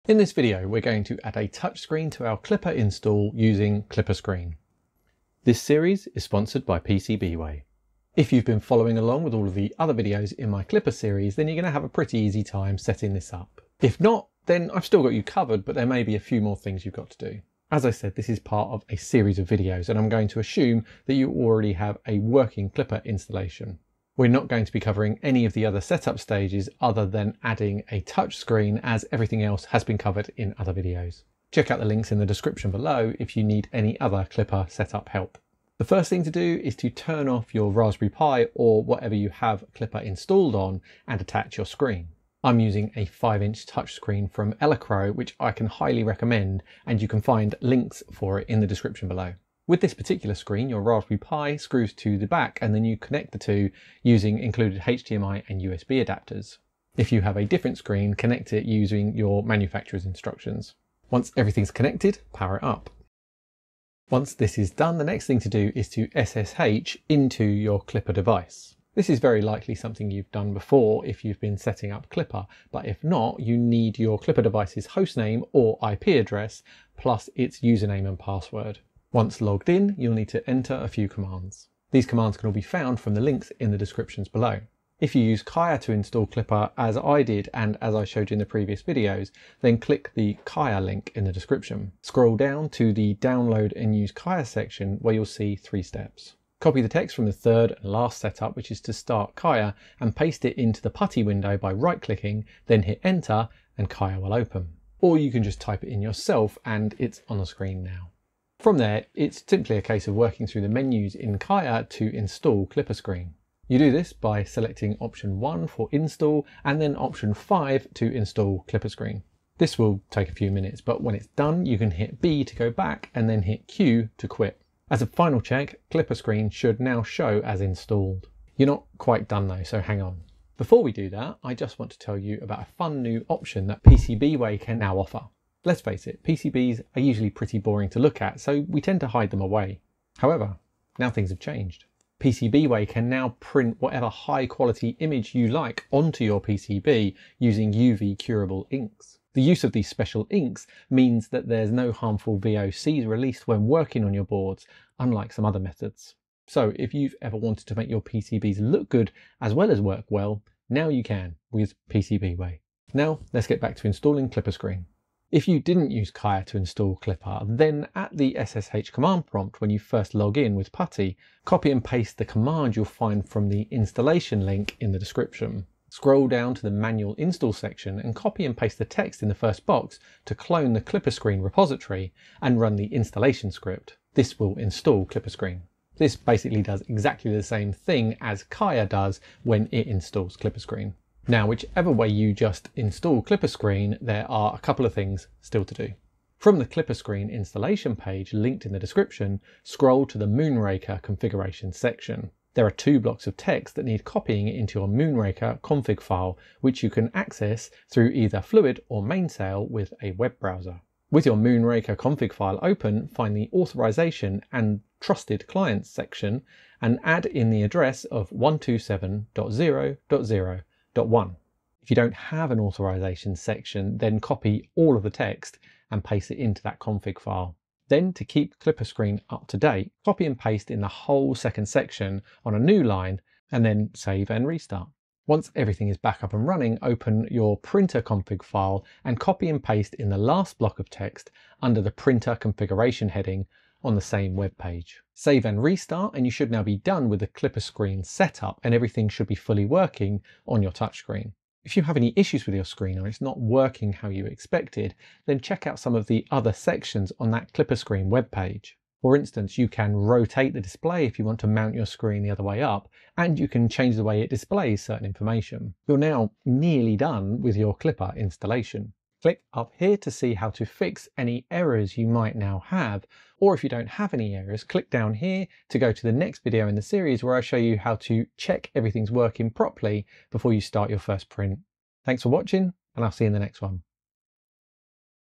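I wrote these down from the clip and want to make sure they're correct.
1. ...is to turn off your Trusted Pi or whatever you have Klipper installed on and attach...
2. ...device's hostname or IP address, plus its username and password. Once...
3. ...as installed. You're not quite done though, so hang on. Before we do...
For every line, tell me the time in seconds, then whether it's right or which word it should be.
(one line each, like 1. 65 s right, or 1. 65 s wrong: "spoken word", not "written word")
1. 36 s wrong: "Raspberry", not "Trusted"
2. 74 s right
3. 127 s right.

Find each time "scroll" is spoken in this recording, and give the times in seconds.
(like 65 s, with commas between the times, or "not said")
92 s, 175 s, 199 s.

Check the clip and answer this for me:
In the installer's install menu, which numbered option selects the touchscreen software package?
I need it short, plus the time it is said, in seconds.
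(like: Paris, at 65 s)
5, at 116 s.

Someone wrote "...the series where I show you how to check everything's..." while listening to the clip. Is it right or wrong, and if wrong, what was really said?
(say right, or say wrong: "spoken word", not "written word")
right.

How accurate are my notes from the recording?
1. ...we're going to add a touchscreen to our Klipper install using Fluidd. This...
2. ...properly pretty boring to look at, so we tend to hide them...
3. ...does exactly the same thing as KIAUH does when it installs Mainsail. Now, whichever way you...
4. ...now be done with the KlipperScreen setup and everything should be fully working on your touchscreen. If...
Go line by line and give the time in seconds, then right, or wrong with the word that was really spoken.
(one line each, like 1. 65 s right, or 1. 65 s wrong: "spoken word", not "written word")
1. 0 s wrong: "KlipperScreen", not "Fluidd"
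2. 137 s wrong: "usually", not "properly"
3. 186 s wrong: "KlipperScreen", not "Mainsail"
4. 246 s right.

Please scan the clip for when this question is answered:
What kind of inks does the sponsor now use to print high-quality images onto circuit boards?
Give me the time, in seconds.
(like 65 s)
147 s.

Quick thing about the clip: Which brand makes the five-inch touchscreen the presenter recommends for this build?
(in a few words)
Elecrow.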